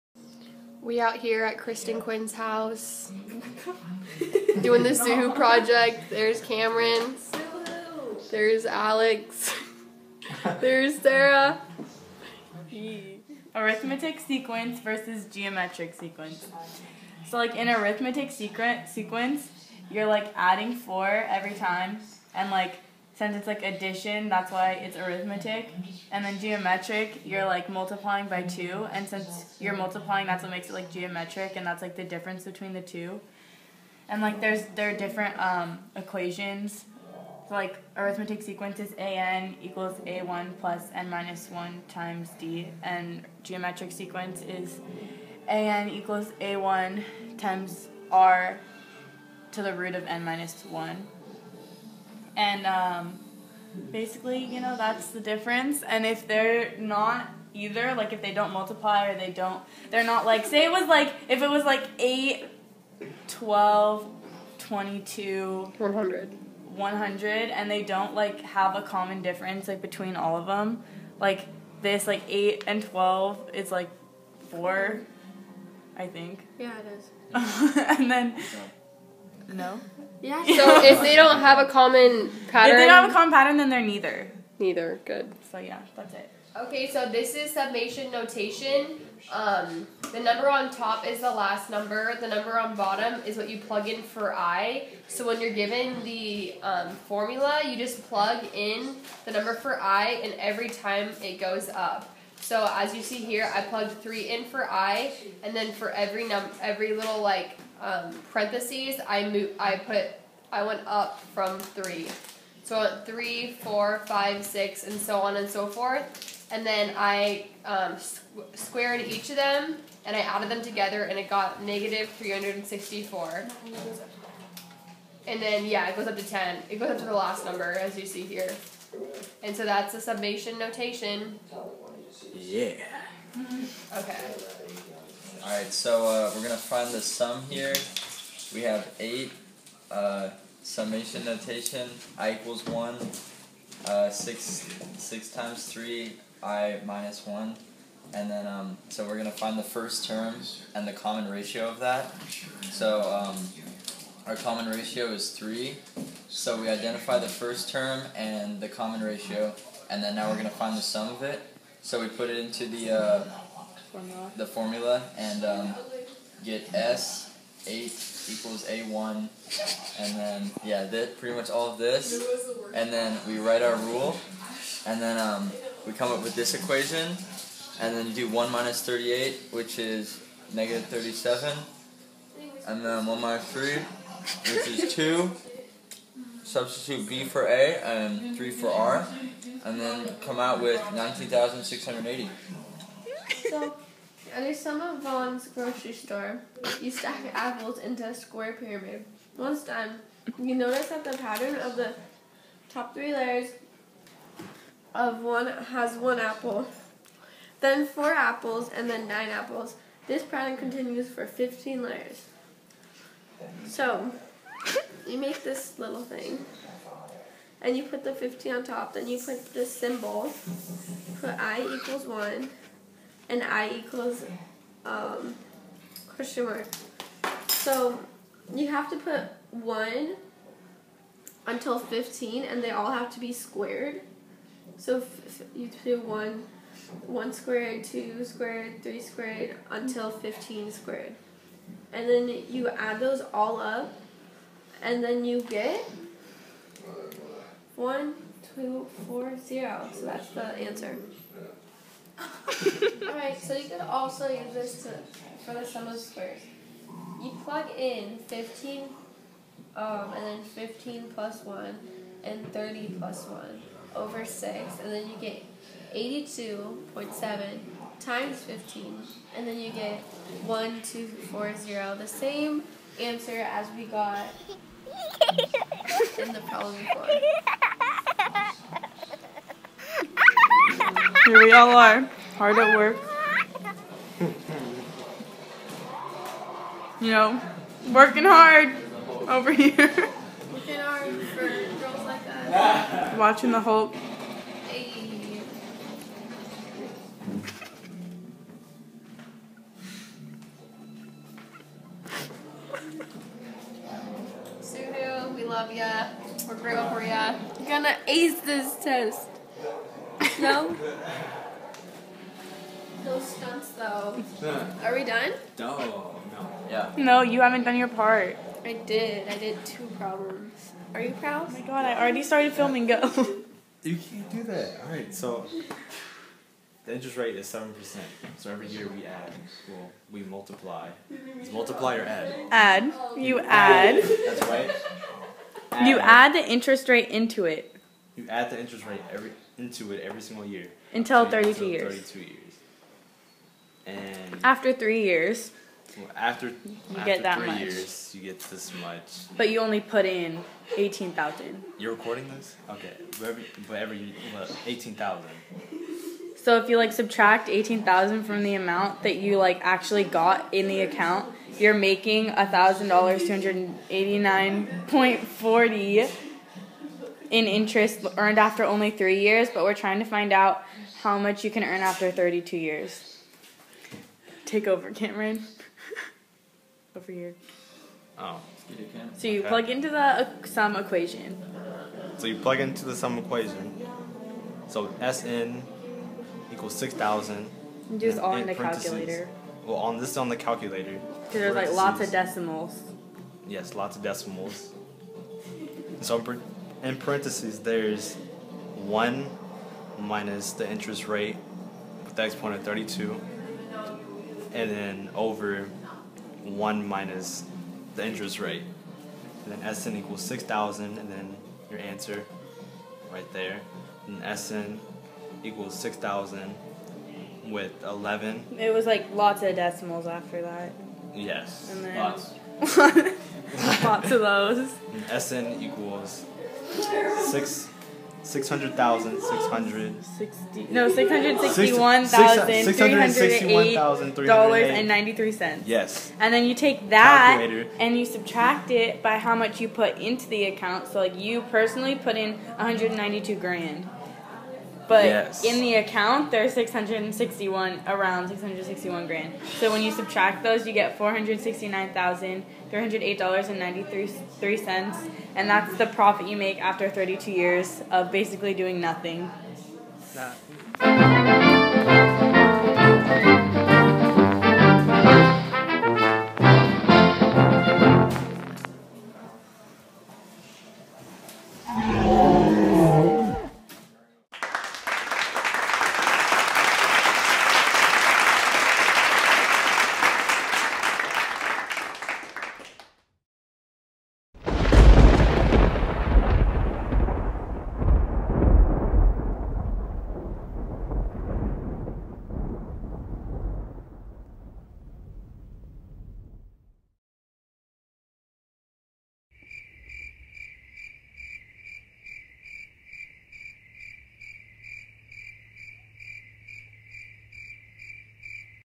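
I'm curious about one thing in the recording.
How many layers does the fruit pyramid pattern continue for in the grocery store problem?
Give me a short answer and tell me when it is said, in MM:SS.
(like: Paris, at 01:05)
15, at 03:31.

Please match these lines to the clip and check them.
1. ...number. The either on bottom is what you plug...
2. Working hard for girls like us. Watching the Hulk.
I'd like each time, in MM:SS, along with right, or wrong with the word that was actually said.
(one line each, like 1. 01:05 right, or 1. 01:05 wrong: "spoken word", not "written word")
1. 01:31 wrong: "number", not "either"
2. 04:49 right.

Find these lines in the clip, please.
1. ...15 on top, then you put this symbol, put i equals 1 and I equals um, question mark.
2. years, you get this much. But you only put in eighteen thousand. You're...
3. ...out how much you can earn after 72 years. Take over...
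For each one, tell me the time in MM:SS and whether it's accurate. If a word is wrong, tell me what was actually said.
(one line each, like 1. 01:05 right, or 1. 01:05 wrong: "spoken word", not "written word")
1. 03:38 right
2. 05:47 right
3. 06:10 wrong: "32", not "72".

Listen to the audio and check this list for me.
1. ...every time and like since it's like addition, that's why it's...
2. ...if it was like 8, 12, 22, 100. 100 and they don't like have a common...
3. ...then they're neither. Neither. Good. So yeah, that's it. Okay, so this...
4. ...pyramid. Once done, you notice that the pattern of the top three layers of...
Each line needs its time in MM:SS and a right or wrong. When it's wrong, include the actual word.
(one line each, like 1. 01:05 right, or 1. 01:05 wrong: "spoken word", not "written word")
1. 00:21 right
2. 01:01 right
3. 01:23 right
4. 03:18 right.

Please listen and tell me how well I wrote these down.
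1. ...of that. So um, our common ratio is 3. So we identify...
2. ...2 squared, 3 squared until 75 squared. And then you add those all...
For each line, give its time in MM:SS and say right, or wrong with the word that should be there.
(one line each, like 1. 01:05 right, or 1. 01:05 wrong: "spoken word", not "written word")
1. 02:31 right
2. 03:57 wrong: "15", not "75".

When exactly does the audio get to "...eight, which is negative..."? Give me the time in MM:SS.
02:59.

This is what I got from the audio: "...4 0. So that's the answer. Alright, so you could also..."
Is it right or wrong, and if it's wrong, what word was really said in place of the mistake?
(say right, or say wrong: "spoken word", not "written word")
right.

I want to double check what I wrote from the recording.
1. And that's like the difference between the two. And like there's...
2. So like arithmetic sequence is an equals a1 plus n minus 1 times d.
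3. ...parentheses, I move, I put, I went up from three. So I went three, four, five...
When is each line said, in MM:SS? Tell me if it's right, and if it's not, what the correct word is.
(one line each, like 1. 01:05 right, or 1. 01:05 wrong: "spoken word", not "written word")
1. 00:31 right
2. 00:37 right
3. 01:48 right.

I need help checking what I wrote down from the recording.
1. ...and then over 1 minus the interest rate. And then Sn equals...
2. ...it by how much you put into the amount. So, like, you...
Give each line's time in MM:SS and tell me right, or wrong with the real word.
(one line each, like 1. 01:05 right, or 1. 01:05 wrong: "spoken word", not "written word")
1. 06:44 right
2. 07:18 wrong: "account", not "amount".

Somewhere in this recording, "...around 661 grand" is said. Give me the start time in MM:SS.
07:27.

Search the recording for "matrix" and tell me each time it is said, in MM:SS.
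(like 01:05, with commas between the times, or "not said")
not said.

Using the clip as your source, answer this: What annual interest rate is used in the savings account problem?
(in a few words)
7%.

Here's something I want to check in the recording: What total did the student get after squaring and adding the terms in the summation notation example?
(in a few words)
-364.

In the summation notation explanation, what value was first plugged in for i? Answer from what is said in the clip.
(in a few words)
3.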